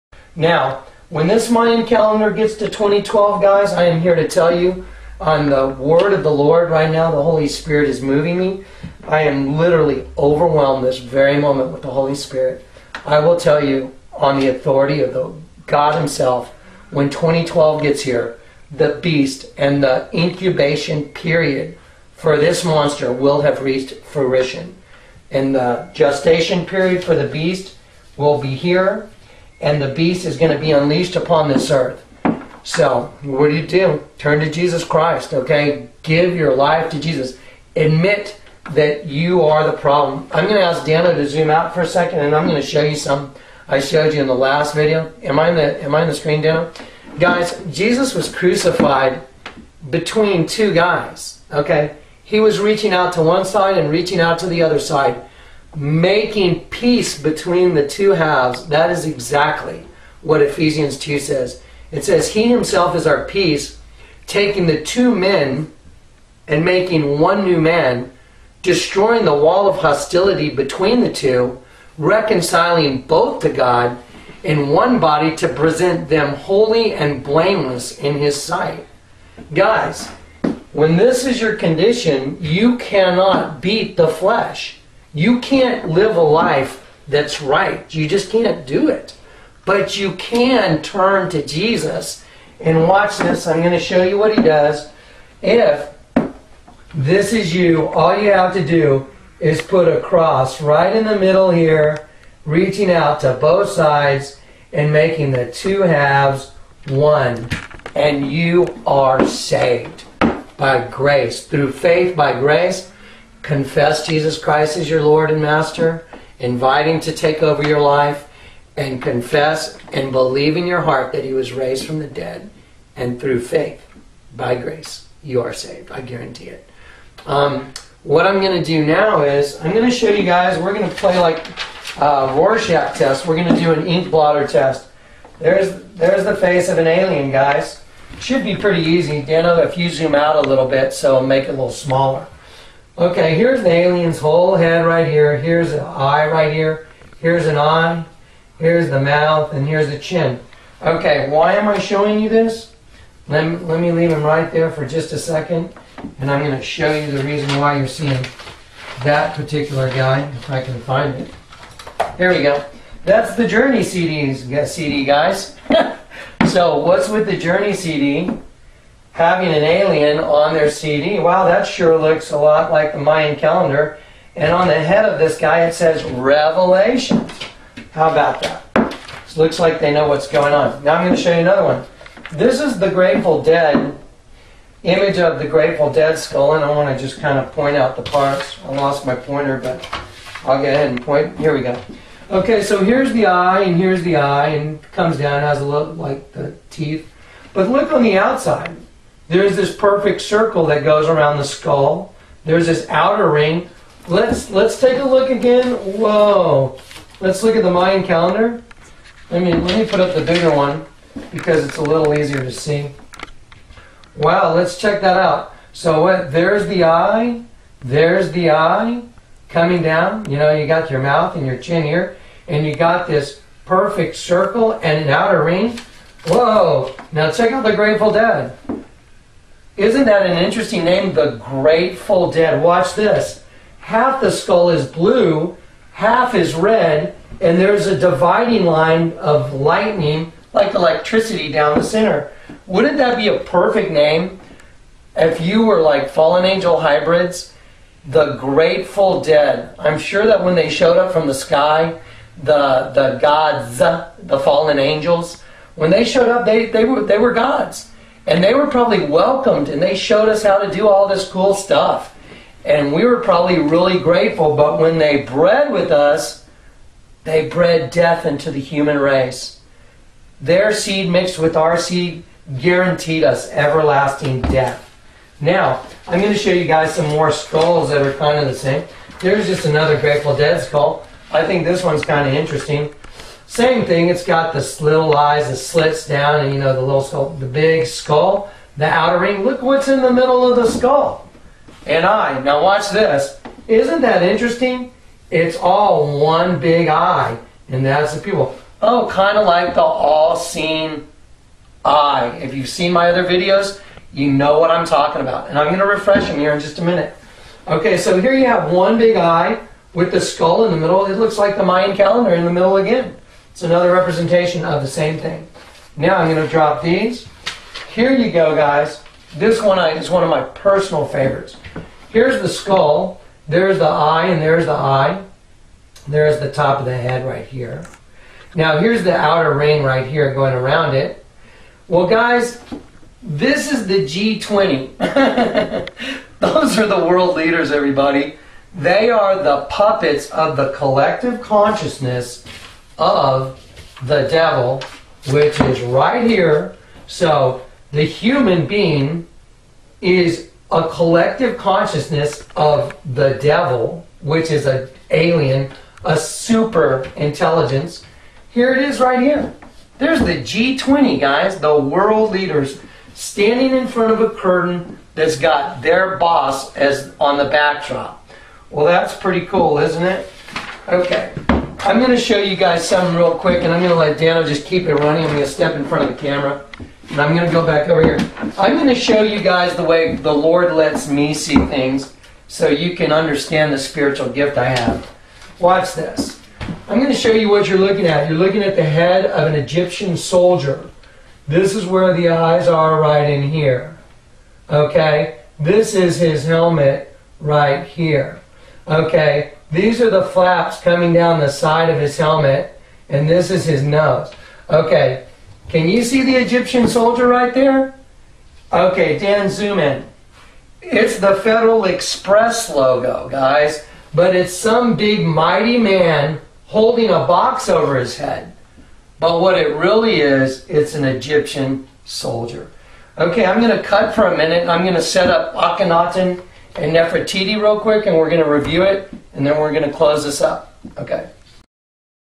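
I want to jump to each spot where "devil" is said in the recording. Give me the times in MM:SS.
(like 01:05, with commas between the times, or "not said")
05:44, 05:53.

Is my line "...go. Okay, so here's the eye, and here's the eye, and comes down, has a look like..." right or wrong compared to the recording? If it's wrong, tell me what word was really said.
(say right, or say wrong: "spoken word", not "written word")
right.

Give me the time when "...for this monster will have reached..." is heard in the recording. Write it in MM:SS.
00:22.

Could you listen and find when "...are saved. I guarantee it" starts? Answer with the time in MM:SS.
02:05.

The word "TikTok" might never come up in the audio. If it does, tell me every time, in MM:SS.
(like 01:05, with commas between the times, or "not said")
not said.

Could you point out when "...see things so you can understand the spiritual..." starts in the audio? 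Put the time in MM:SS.
06:21.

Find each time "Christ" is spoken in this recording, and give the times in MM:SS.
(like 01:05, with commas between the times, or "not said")
00:34, 01:54.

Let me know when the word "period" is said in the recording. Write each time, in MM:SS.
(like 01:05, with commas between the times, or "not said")
00:21, 00:26.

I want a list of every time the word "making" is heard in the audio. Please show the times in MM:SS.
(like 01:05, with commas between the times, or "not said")
00:55, 01:06, 01:44.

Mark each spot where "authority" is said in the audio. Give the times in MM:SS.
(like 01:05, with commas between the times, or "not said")
00:14.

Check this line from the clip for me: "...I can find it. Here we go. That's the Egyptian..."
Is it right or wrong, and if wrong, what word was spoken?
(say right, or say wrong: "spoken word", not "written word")
wrong: "Journey", not "Egyptian".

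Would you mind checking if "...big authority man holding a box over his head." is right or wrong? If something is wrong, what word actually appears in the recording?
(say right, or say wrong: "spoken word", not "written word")
wrong: "mighty", not "authority".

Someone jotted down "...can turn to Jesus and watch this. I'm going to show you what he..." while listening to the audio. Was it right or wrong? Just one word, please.
right.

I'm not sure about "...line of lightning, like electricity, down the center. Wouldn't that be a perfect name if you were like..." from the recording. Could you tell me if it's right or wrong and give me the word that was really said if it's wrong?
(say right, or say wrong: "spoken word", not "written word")
right.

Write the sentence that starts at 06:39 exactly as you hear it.
These are the flaps coming down the side of his helmet, and this is his nose.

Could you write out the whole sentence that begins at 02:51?
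Wow, that sure looks a lot like the Mayan calendar.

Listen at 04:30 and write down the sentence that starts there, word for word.
Their seed mixed with our seed guaranteed us everlasting death.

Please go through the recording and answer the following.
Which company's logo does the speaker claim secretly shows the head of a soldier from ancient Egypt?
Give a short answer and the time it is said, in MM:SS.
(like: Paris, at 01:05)
Federal Express, at 06:51.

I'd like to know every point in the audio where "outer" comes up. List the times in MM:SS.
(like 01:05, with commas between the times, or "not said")
03:22, 03:45, 04:48, 05:29.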